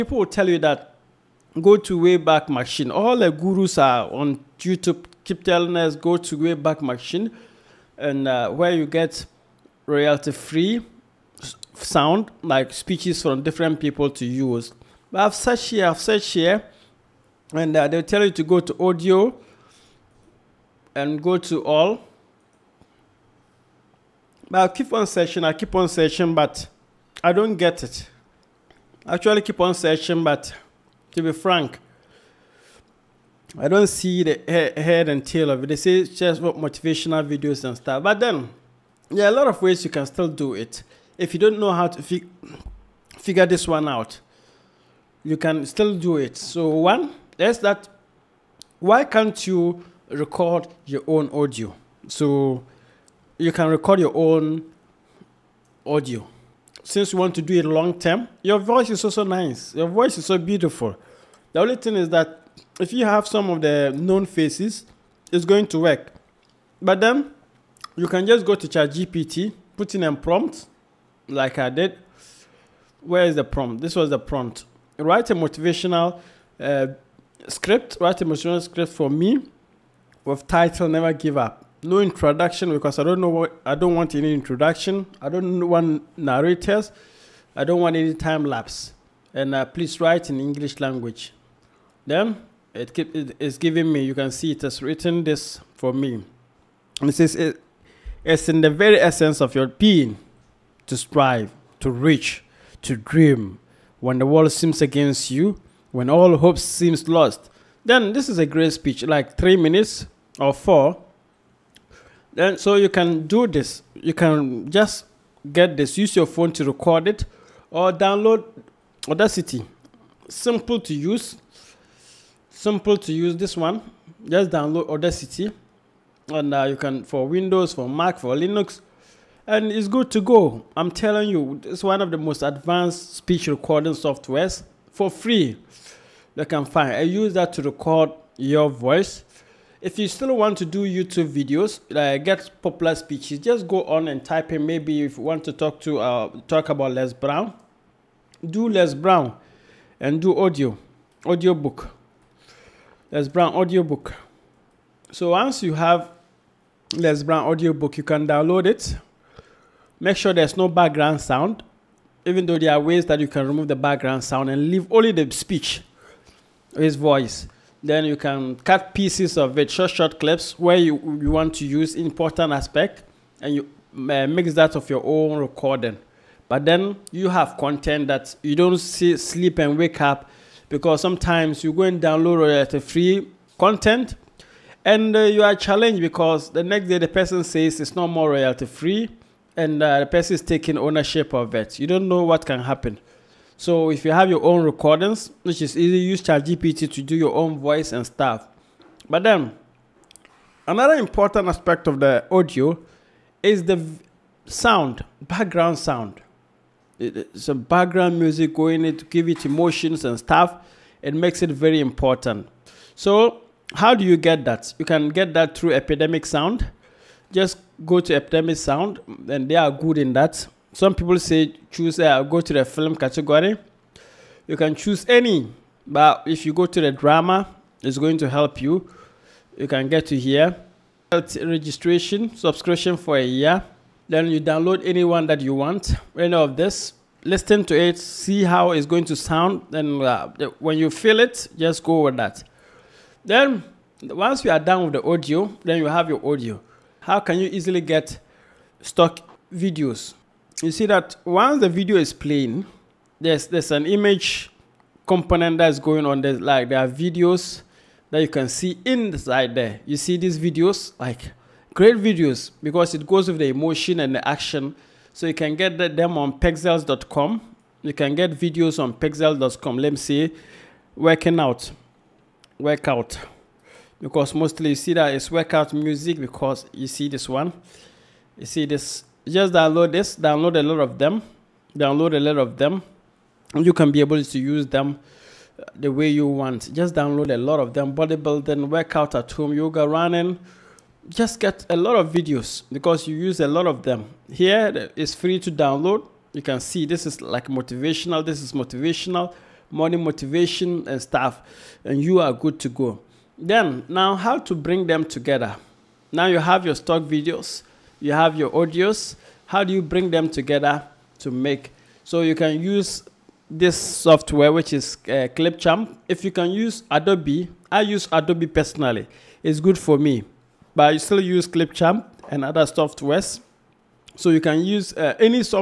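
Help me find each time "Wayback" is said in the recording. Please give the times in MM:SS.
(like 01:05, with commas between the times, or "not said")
00:01, 00:06.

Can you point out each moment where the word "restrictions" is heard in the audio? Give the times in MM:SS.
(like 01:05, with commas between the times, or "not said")
not said.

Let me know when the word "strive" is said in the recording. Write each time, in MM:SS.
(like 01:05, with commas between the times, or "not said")
01:40.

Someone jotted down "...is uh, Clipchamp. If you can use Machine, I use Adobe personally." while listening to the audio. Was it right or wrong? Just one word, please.
wrong.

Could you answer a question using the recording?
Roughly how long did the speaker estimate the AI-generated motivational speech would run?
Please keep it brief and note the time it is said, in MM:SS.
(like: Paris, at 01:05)
3 minutes, at 01:49.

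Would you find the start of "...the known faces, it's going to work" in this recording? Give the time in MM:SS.
01:03.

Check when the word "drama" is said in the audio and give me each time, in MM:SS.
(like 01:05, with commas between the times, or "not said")
03:46.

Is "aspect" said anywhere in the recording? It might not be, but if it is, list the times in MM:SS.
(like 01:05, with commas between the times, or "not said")
02:52, 03:21.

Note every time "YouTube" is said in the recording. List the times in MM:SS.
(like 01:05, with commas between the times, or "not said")
00:04, 02:20.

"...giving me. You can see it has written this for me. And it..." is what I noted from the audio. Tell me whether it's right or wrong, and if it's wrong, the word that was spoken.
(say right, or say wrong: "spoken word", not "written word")
right.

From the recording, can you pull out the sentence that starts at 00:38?
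But then, there are a lot of ways you can still do it.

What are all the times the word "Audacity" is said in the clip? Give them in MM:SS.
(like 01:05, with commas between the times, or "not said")
01:59, 02:04.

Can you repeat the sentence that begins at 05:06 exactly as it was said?
Now you have your stock videos, you have your audios.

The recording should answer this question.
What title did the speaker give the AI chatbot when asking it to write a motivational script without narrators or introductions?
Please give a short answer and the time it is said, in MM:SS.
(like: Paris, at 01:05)
Never Give Up, at 01:20.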